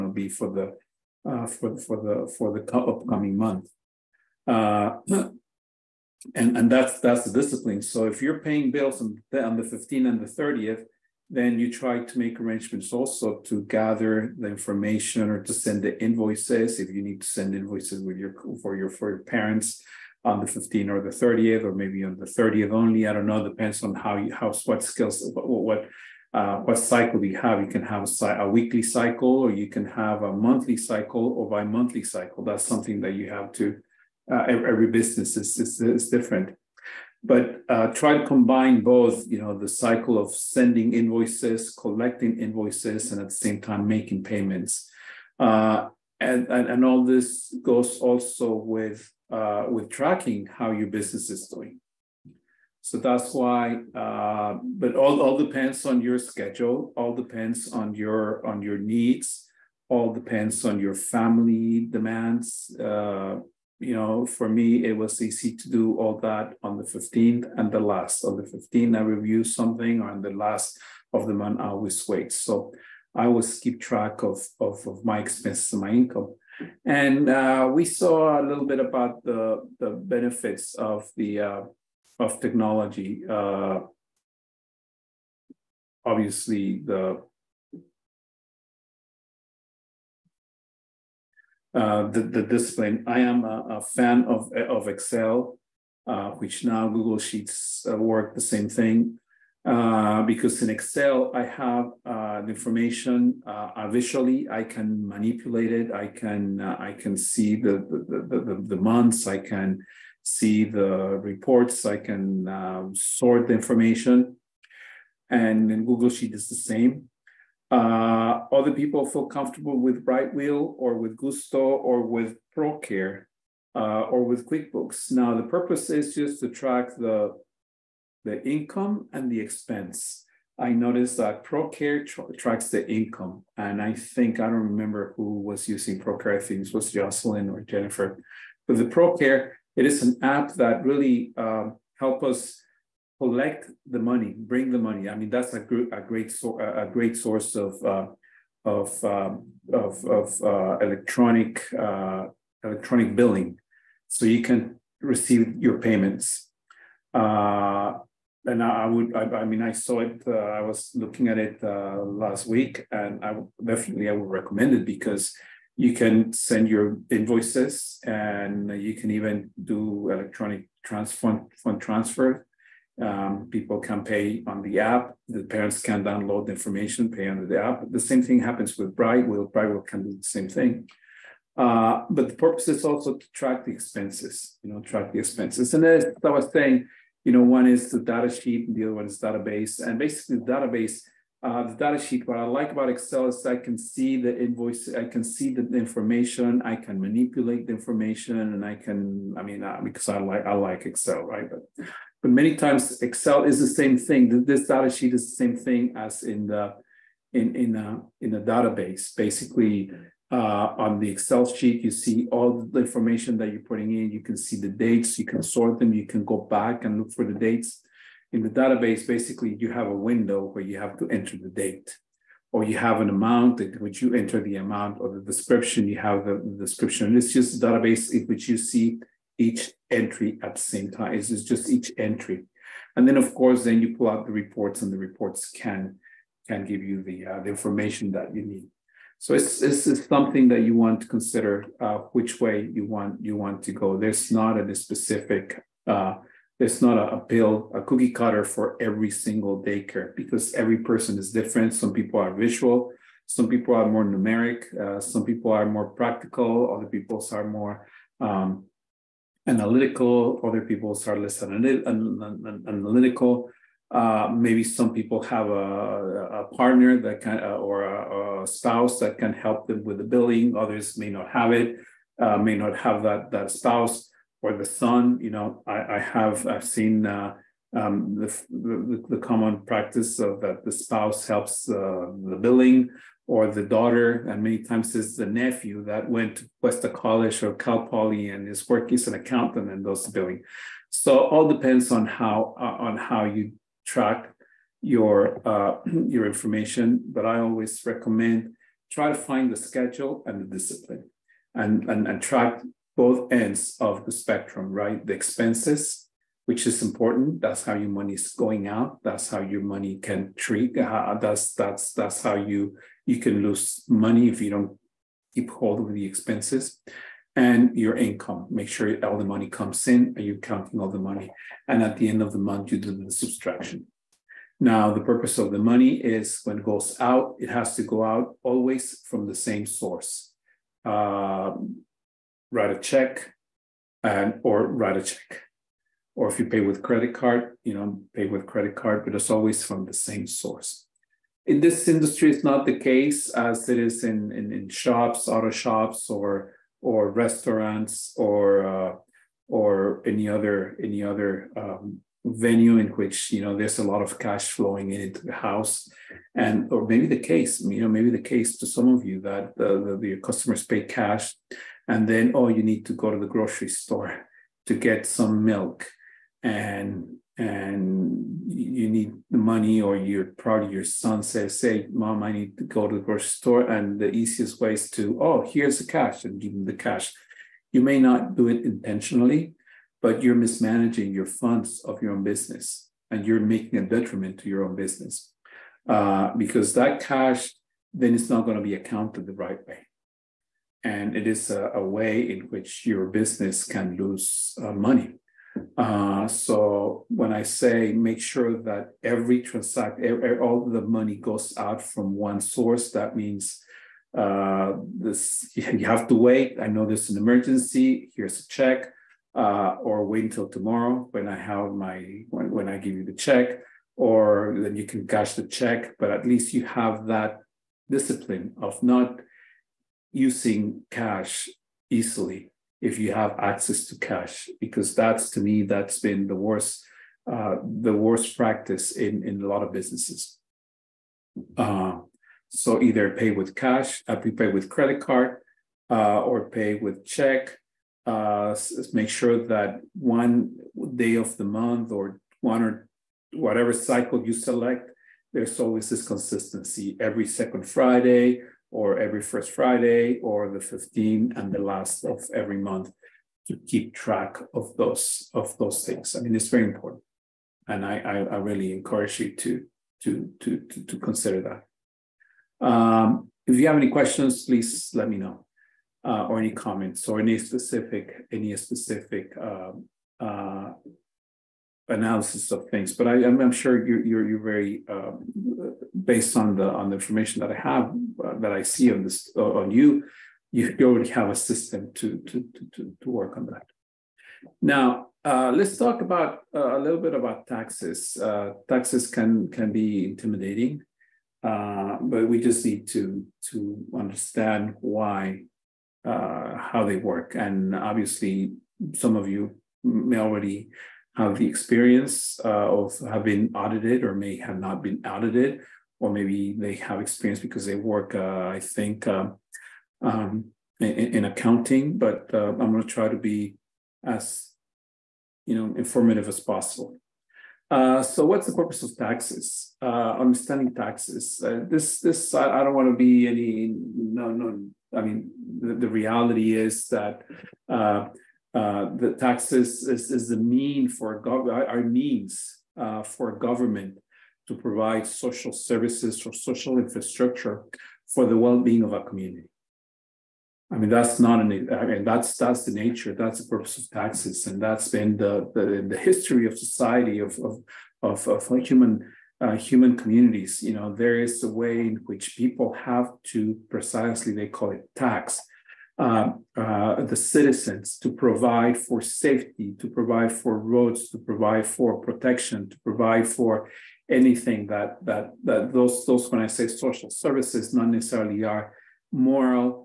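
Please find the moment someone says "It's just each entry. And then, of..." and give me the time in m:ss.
3:51.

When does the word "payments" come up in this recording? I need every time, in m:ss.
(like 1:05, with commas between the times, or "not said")
0:44, 2:35.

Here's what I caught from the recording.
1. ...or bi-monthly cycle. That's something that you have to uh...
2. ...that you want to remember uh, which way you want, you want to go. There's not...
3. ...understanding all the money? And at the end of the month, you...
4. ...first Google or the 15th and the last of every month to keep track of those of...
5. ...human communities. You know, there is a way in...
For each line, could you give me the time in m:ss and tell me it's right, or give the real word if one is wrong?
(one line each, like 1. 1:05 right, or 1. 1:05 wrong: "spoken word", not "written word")
1. 0:31 right
2. 4:00 wrong: "consider", not "remember"
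3. 5:20 wrong: "counting", not "understanding"
4. 7:29 wrong: "Friday", not "Google"
5. 9:09 right.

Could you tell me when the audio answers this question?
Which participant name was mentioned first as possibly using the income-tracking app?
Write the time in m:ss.
2:16.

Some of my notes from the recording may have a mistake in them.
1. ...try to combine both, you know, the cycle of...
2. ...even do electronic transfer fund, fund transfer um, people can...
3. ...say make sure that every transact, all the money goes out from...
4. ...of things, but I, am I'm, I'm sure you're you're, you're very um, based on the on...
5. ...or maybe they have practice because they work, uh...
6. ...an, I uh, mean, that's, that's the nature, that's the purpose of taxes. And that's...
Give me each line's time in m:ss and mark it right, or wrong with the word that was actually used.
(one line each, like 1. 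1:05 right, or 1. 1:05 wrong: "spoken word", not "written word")
1. 0:37 right
2. 2:49 right
3. 6:37 right
4. 7:52 right
5. 8:25 wrong: "experience", not "practice"
6. 9:01 right.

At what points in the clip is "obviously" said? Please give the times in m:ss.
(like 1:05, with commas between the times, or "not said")
1:26, 8:17.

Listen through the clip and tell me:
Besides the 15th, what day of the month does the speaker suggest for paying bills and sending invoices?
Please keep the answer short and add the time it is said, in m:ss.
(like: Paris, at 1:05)
30th, at 0:09.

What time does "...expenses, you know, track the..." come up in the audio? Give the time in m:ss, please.
3:03.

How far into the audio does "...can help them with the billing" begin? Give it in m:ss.
4:29.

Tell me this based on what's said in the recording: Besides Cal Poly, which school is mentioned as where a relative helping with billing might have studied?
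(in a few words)
Cuesta College.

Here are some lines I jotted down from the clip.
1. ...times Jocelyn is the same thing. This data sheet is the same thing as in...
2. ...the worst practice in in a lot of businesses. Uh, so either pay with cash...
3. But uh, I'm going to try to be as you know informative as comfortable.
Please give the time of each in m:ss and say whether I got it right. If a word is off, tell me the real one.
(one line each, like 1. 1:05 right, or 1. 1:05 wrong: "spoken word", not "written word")
1. 3:22 wrong: "Excel", not "Jocelyn"
2. 7:07 right
3. 8:31 wrong: "possible", not "comfortable".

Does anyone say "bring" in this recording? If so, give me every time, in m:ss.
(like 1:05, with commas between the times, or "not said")
2:24.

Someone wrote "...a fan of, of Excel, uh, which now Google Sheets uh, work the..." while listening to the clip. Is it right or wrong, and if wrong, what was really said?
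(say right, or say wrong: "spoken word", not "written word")
right.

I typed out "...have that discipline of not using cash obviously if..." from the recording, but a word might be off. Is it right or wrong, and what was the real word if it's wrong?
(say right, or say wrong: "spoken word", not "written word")
wrong: "easily", not "obviously".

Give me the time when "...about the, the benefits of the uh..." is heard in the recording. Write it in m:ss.
1:18.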